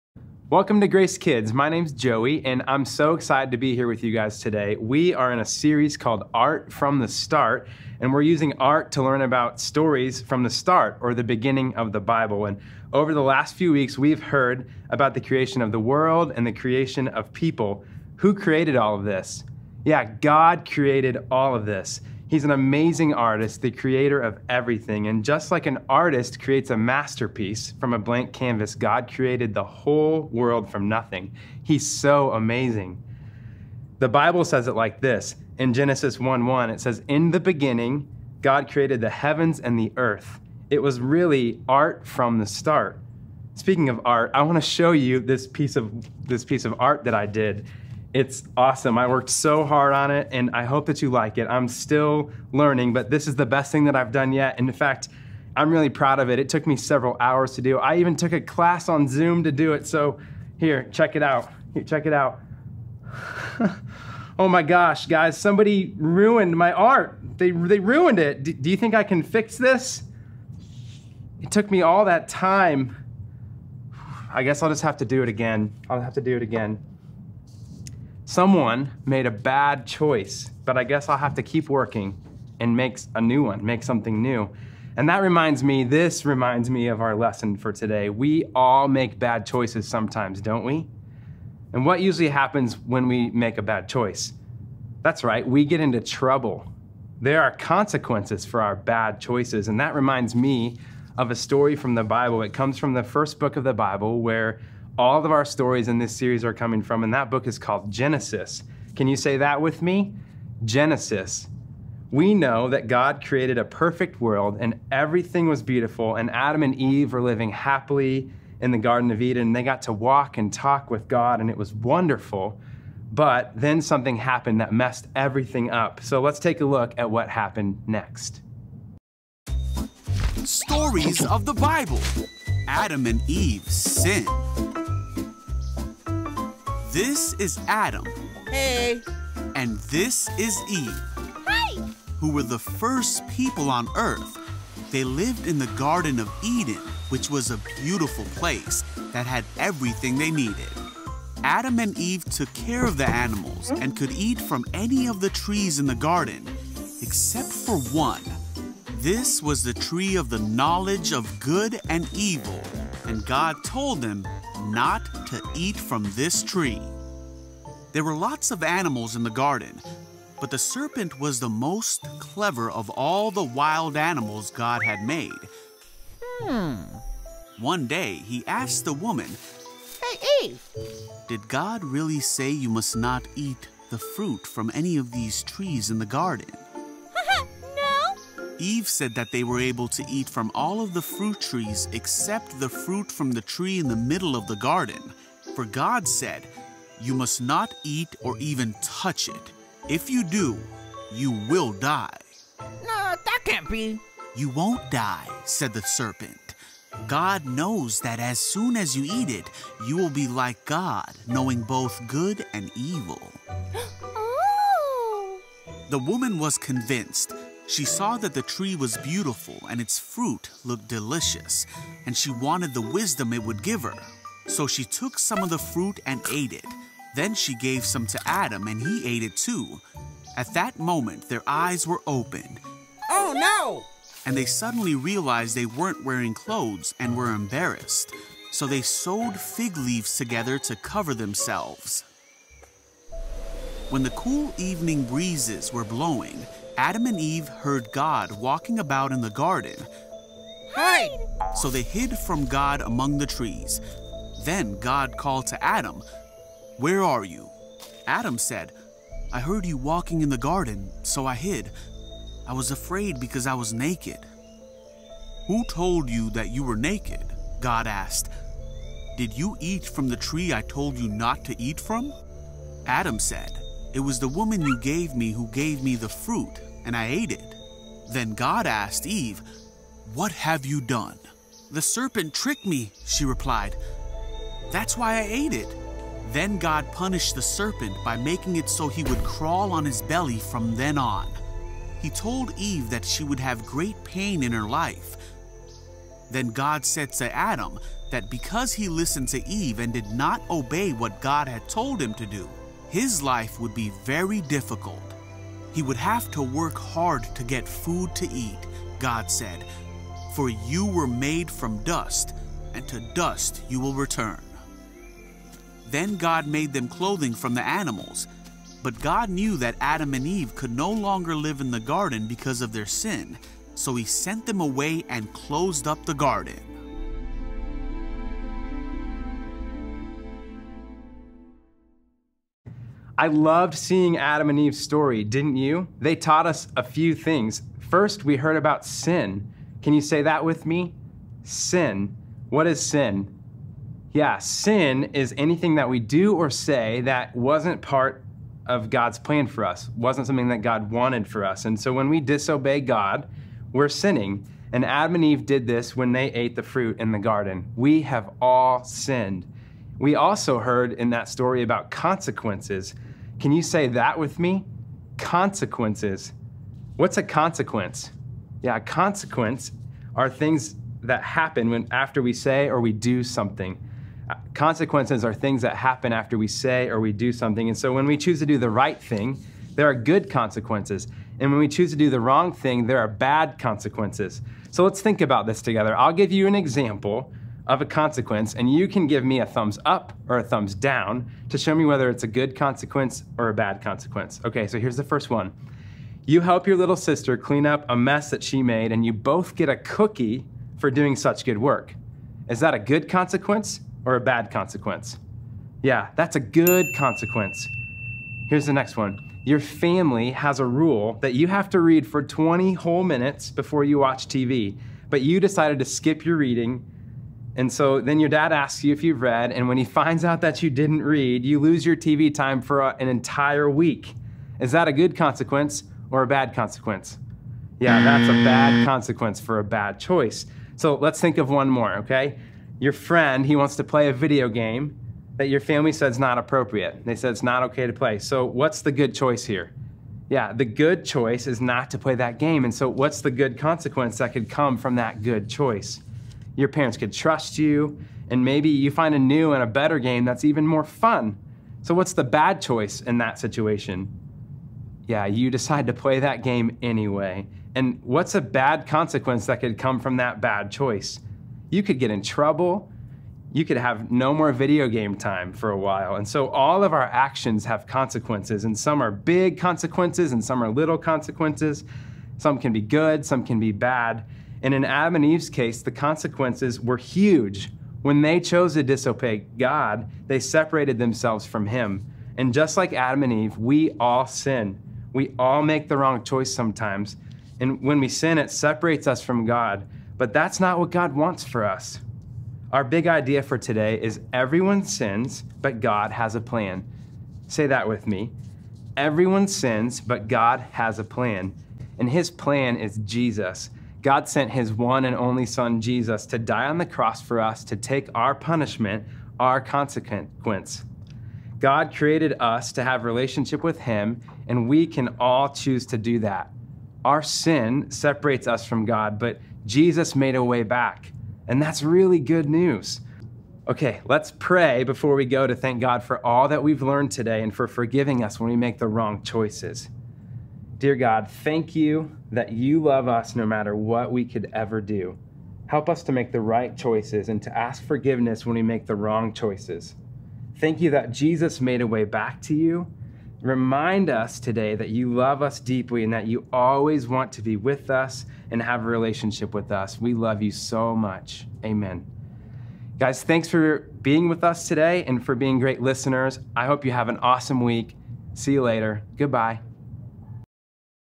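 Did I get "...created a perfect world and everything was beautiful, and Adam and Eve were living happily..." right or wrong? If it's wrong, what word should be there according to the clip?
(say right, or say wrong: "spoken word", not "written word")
right.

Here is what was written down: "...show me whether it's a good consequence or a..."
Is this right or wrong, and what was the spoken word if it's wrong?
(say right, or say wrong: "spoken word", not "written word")
right.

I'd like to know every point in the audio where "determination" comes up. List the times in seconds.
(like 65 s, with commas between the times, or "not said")
not said.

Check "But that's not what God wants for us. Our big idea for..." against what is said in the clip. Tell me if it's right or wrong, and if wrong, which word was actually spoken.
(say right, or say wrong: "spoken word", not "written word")
right.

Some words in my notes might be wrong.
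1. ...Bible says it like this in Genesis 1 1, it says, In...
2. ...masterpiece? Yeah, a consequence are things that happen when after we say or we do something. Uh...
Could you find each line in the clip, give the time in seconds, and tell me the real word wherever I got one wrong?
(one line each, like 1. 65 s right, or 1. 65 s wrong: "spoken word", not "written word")
1. 34 s right
2. 367 s wrong: "consequence", not "masterpiece".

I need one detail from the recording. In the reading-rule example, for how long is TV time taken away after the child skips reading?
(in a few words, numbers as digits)
An entire week.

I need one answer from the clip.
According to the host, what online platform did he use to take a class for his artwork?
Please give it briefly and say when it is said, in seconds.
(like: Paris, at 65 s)
Zoom, at 59 s.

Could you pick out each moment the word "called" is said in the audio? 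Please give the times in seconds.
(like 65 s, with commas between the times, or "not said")
5 s, 107 s, 255 s.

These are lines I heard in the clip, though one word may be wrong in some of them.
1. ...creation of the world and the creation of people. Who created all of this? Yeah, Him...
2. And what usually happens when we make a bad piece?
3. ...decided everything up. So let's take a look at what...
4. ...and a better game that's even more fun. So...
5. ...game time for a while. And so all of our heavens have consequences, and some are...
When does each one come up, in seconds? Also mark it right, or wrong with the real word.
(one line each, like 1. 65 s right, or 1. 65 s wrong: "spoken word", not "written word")
1. 15 s wrong: "God", not "Him"
2. 91 s wrong: "choice", not "piece"
3. 124 s wrong: "messed", not "decided"
4. 449 s right
5. 464 s wrong: "actions", not "heavens".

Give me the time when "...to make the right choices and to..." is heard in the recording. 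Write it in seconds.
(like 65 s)
536 s.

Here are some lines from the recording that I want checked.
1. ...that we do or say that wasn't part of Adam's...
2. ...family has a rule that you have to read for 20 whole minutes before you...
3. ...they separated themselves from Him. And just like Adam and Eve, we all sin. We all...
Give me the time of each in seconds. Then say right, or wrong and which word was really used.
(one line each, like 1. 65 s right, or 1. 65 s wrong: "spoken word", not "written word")
1. 345 s wrong: "God", not "Adam"
2. 409 s right
3. 480 s right.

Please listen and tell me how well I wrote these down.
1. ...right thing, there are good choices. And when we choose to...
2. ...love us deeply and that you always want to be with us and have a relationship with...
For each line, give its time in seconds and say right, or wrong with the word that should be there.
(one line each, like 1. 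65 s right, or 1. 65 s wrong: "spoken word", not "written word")
1. 378 s wrong: "consequences", not "choices"
2. 545 s right.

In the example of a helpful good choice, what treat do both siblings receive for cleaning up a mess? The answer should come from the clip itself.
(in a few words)
A cookie.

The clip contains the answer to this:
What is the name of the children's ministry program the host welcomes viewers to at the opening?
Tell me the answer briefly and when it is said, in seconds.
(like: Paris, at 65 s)
Grace Kids, at 0 s.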